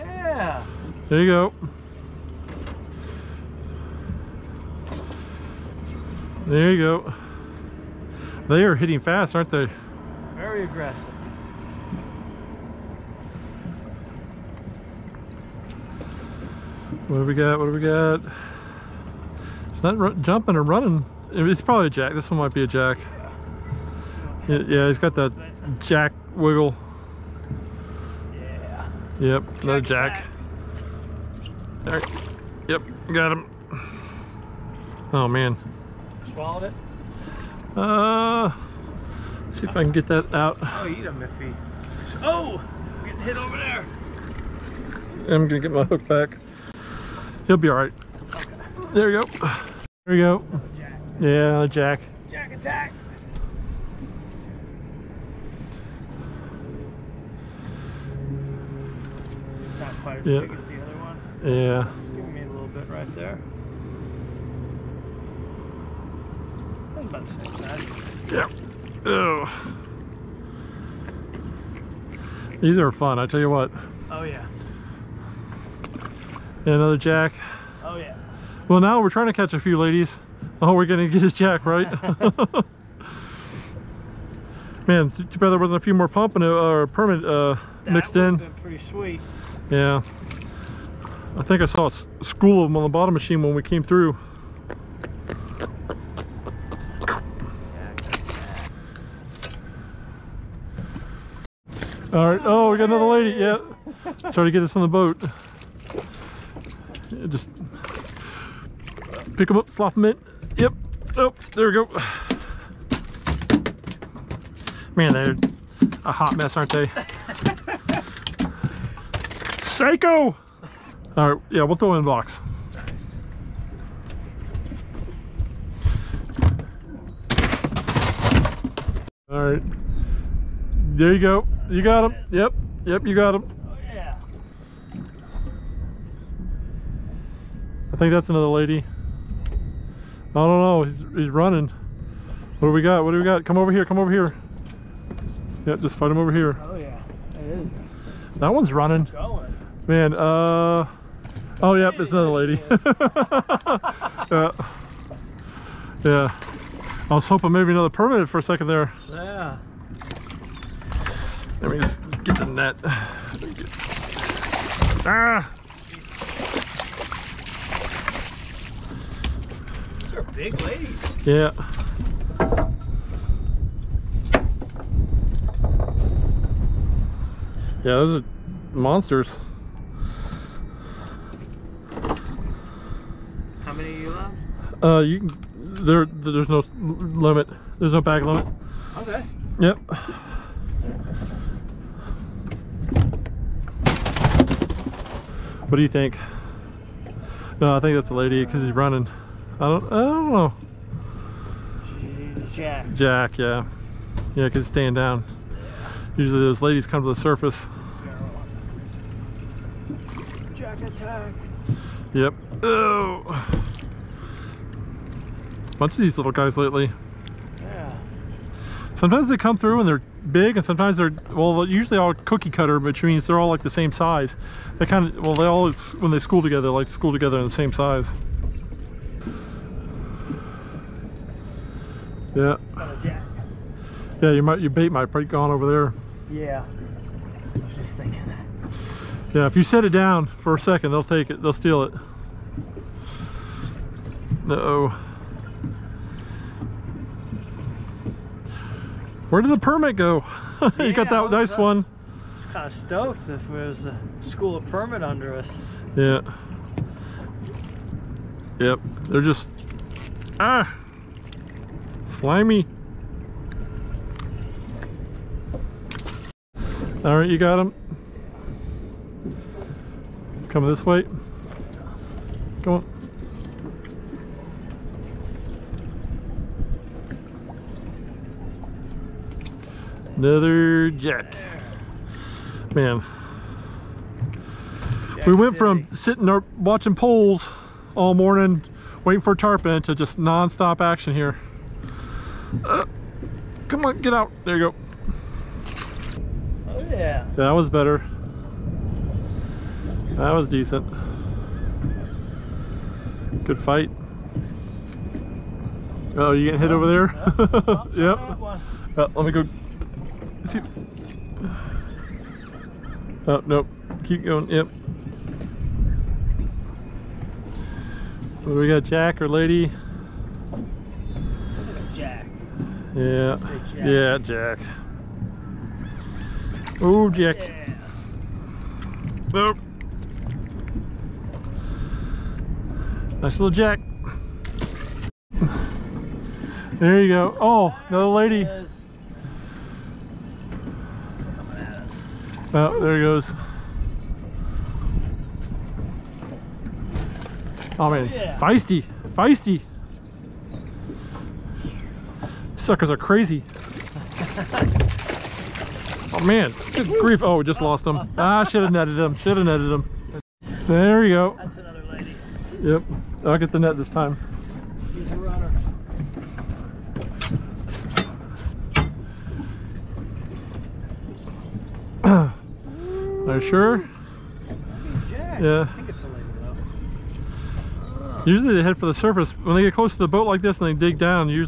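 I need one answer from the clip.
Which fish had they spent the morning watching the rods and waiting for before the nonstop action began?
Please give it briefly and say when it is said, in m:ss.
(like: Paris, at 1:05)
Tarpon, at 4:49.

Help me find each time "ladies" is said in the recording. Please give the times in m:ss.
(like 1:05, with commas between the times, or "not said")
1:19, 2:50, 3:26.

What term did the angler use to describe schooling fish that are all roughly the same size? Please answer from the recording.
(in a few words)
Cookie cutter.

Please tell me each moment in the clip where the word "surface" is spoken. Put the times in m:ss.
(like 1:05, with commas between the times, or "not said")
3:27, 6:18.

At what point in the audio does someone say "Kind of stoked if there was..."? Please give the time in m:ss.
4:12.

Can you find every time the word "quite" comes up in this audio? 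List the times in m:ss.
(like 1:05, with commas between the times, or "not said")
1:00.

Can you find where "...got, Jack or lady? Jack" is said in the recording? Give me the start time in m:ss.
5:18.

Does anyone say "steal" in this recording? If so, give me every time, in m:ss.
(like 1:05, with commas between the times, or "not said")
4:01.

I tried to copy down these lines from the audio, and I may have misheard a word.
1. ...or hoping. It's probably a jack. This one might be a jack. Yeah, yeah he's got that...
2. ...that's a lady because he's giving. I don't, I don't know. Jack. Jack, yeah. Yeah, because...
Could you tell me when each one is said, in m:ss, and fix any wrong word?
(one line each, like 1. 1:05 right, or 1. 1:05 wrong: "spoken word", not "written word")
1. 0:20 wrong: "running", not "hoping"
2. 3:17 wrong: "running", not "giving".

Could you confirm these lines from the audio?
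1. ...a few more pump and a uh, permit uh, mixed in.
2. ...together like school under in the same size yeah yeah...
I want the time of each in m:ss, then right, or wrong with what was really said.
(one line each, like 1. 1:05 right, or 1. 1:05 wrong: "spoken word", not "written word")
1. 1:25 right
2. 3:46 wrong: "together", not "under".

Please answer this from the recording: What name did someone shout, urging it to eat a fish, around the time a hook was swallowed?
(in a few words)
Miffy.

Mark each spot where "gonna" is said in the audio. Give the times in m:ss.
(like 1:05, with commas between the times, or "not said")
0:45, 1:20.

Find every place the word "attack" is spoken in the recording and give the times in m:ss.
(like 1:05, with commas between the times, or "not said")
0:52, 3:30.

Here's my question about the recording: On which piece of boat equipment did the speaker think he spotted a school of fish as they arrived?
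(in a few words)
Bottom machine.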